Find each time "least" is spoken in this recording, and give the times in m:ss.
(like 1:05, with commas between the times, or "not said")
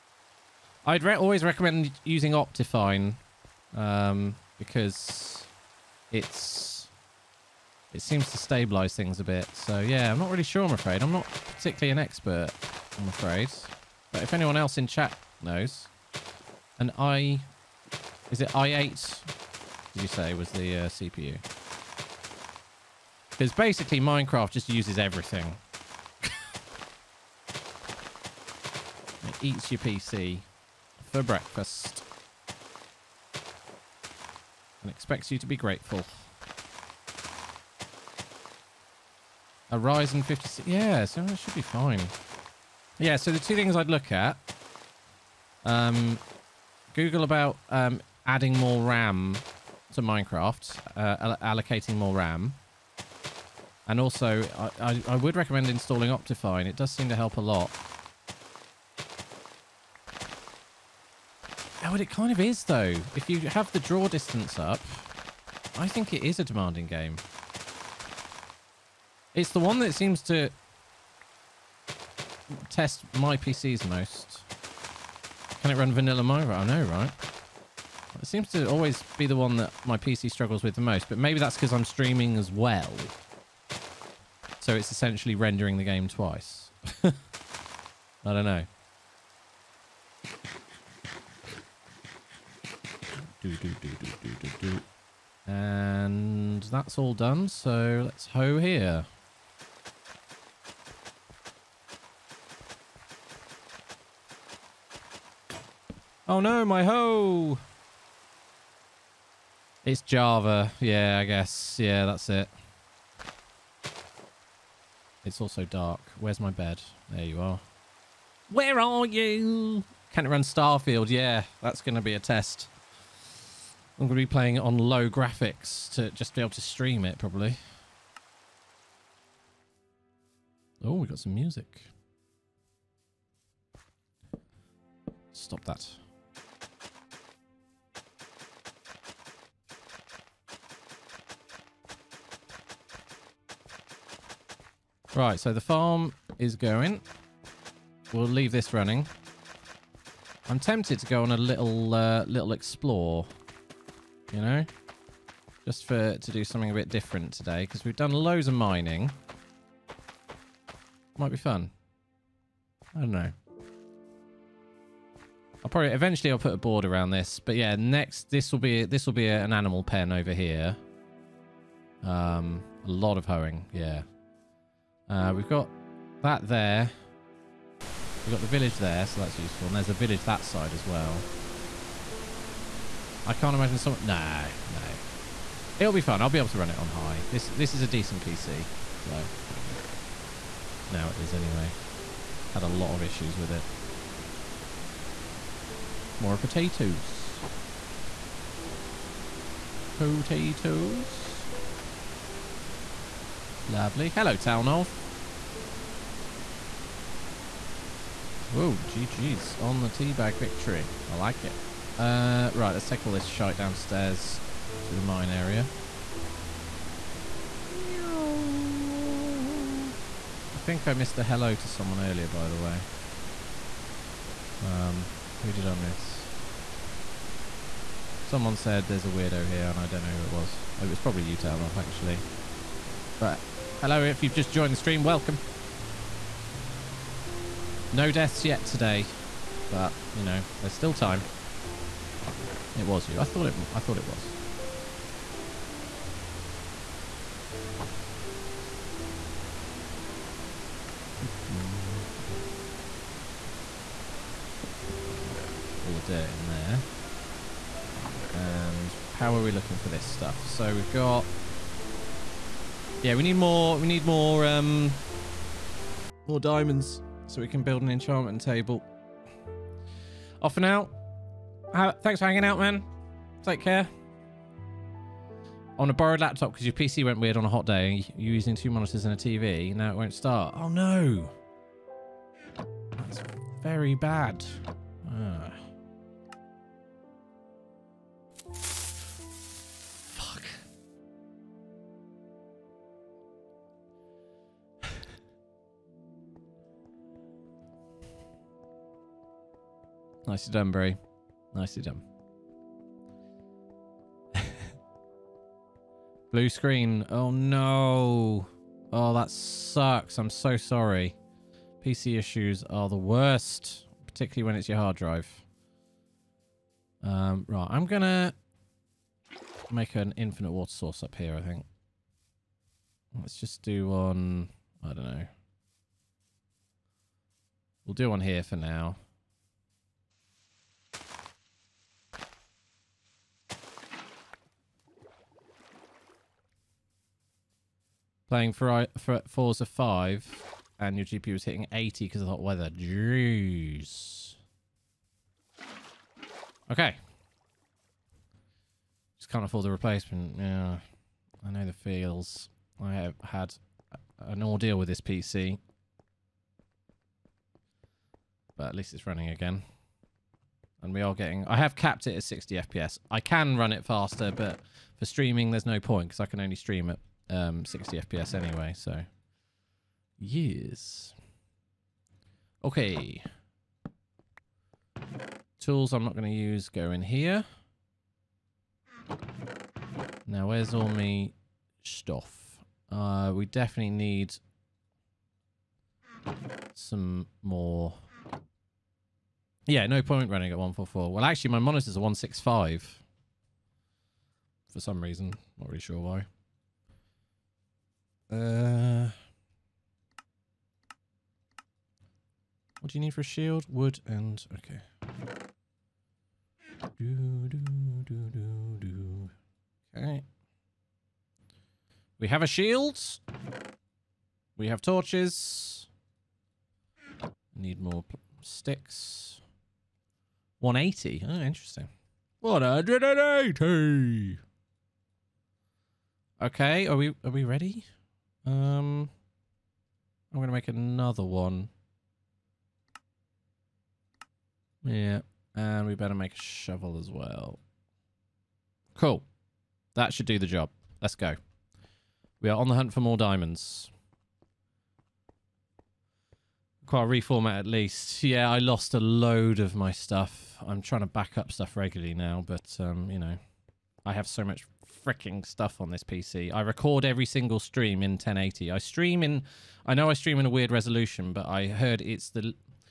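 5:58, 7:27.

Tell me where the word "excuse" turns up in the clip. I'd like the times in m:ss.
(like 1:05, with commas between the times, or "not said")
not said.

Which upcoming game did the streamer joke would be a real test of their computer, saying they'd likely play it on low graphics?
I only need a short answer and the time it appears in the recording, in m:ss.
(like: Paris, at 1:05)
Starfield, at 2:00.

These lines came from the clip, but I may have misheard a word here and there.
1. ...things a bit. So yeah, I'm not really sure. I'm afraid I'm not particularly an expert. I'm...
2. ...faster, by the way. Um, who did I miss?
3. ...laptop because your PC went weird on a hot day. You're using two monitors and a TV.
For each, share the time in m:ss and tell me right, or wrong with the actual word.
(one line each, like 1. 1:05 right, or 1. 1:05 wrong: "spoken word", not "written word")
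1. 0:08 right
2. 3:41 wrong: "earlier", not "faster"
3. 4:36 right.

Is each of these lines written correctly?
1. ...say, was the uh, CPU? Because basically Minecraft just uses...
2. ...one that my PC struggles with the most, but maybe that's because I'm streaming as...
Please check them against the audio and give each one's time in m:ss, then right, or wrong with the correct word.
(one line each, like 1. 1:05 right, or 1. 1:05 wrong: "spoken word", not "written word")
1. 0:20 right
2. 1:19 right.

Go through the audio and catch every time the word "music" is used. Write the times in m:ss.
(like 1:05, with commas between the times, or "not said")
2:11.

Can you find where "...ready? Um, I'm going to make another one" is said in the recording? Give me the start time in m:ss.
7:07.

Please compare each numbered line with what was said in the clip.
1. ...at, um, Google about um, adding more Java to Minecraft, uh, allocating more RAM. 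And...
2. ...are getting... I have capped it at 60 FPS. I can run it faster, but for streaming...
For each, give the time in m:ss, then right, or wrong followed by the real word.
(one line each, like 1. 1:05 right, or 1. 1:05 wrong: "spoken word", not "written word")
1. 0:44 wrong: "RAM", not "Java"
2. 6:01 right.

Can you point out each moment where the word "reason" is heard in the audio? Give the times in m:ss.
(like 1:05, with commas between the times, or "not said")
6:35.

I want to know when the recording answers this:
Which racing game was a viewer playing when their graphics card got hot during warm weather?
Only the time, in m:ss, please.
5:39.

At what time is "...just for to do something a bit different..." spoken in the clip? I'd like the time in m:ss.
2:35.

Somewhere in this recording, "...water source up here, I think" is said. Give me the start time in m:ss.
5:20.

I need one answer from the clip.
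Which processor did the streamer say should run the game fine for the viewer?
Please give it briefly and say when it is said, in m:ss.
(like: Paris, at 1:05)
Ryzen 56, at 0:39.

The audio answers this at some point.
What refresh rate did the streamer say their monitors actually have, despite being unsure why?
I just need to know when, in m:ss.
6:31.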